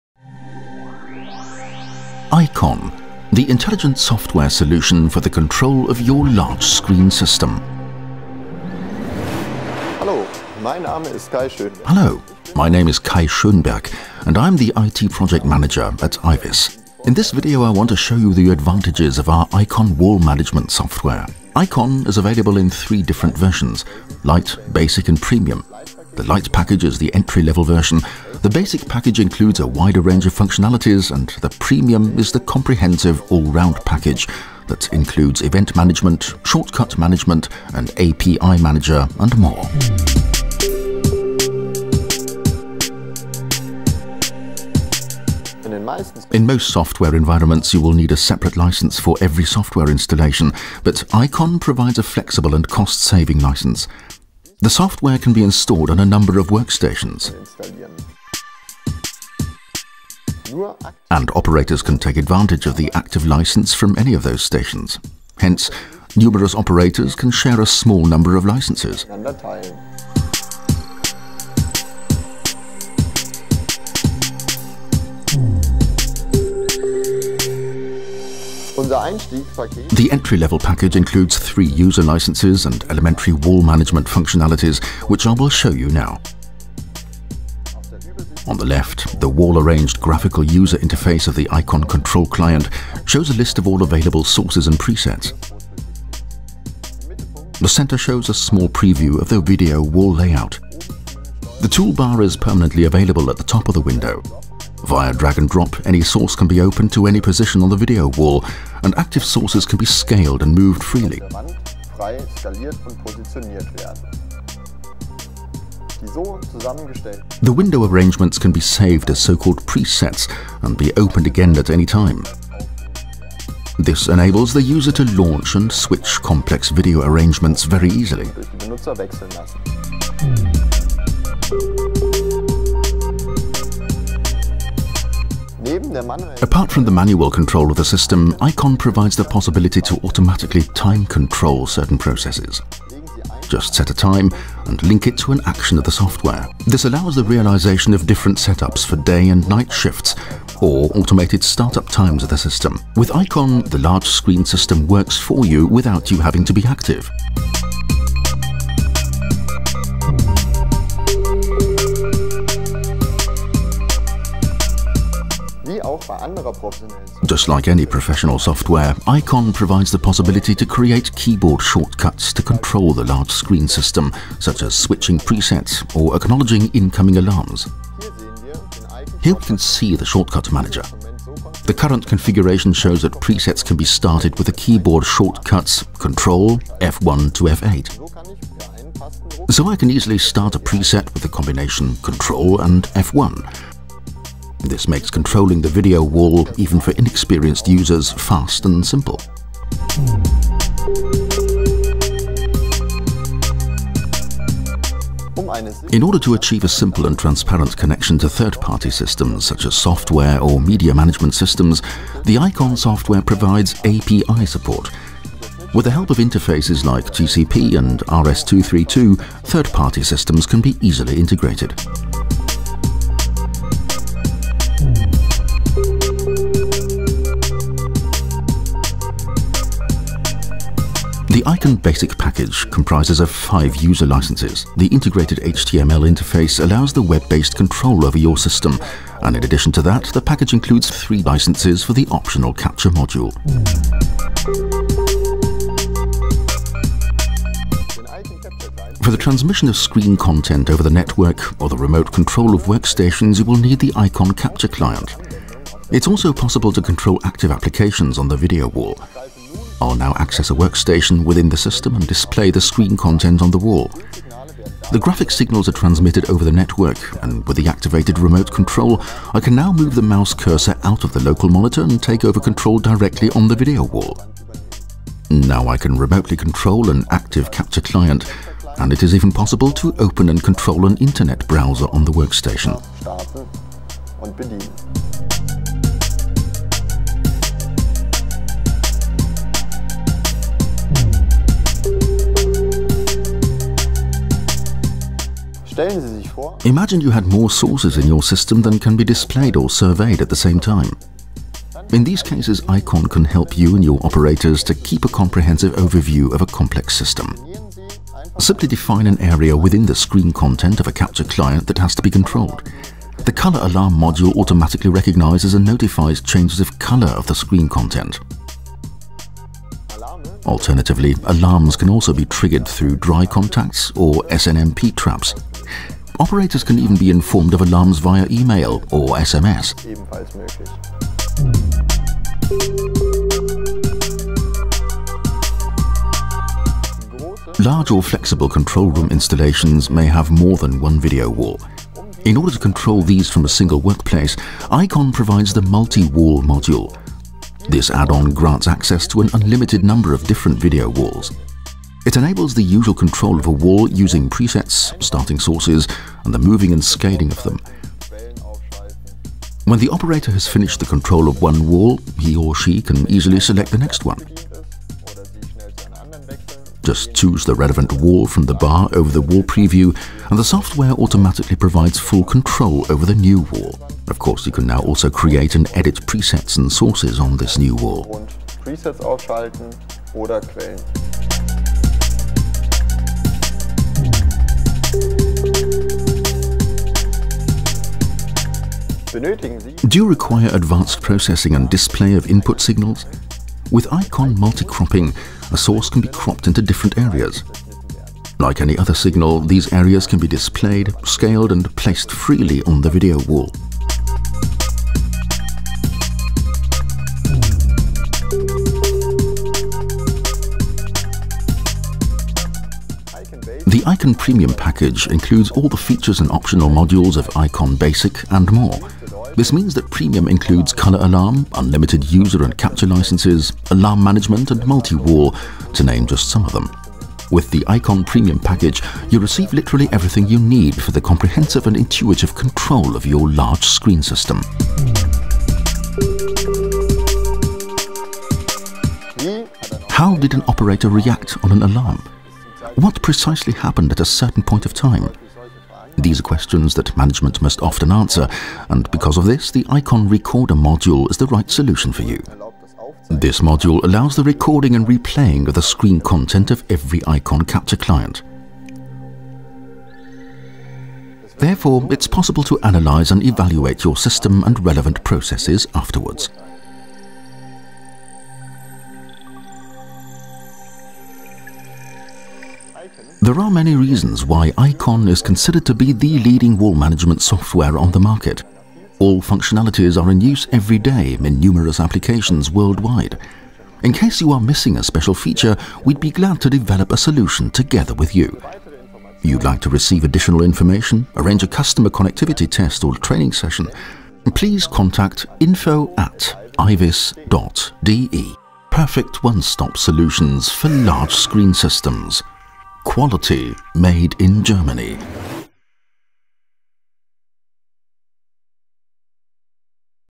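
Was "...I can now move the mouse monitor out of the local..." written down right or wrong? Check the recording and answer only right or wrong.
wrong.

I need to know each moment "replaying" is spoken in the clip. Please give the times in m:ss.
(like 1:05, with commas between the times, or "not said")
7:34.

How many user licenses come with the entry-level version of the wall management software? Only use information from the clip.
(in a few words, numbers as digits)
3.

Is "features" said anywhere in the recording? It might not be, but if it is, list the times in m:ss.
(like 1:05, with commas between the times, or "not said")
6:55, 8:05.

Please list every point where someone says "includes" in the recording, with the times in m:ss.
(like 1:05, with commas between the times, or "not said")
0:29, 0:34, 1:20, 4:00, 6:55, 7:00.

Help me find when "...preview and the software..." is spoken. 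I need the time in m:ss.
6:09.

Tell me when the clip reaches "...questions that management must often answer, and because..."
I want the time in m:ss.
7:26.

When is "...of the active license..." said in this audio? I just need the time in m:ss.
1:02.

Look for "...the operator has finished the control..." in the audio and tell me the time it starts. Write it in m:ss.
5:59.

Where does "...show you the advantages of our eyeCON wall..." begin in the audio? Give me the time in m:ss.
0:17.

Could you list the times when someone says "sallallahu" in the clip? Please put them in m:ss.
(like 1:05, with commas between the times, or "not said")
not said.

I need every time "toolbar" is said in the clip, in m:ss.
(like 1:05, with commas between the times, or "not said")
1:41.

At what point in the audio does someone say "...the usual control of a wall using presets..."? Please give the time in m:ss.
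5:52.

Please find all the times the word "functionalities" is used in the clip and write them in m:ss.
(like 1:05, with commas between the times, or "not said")
0:30, 1:24, 7:59.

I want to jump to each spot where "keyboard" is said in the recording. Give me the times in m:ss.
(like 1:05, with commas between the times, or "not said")
2:51, 3:04.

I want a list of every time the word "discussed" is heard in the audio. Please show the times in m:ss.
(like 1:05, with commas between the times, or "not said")
not said.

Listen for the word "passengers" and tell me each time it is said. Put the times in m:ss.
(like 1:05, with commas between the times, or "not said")
not said.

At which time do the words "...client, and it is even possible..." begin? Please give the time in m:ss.
4:37.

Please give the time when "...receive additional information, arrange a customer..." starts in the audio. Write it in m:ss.
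8:09.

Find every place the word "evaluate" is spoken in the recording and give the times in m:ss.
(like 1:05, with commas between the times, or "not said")
7:43.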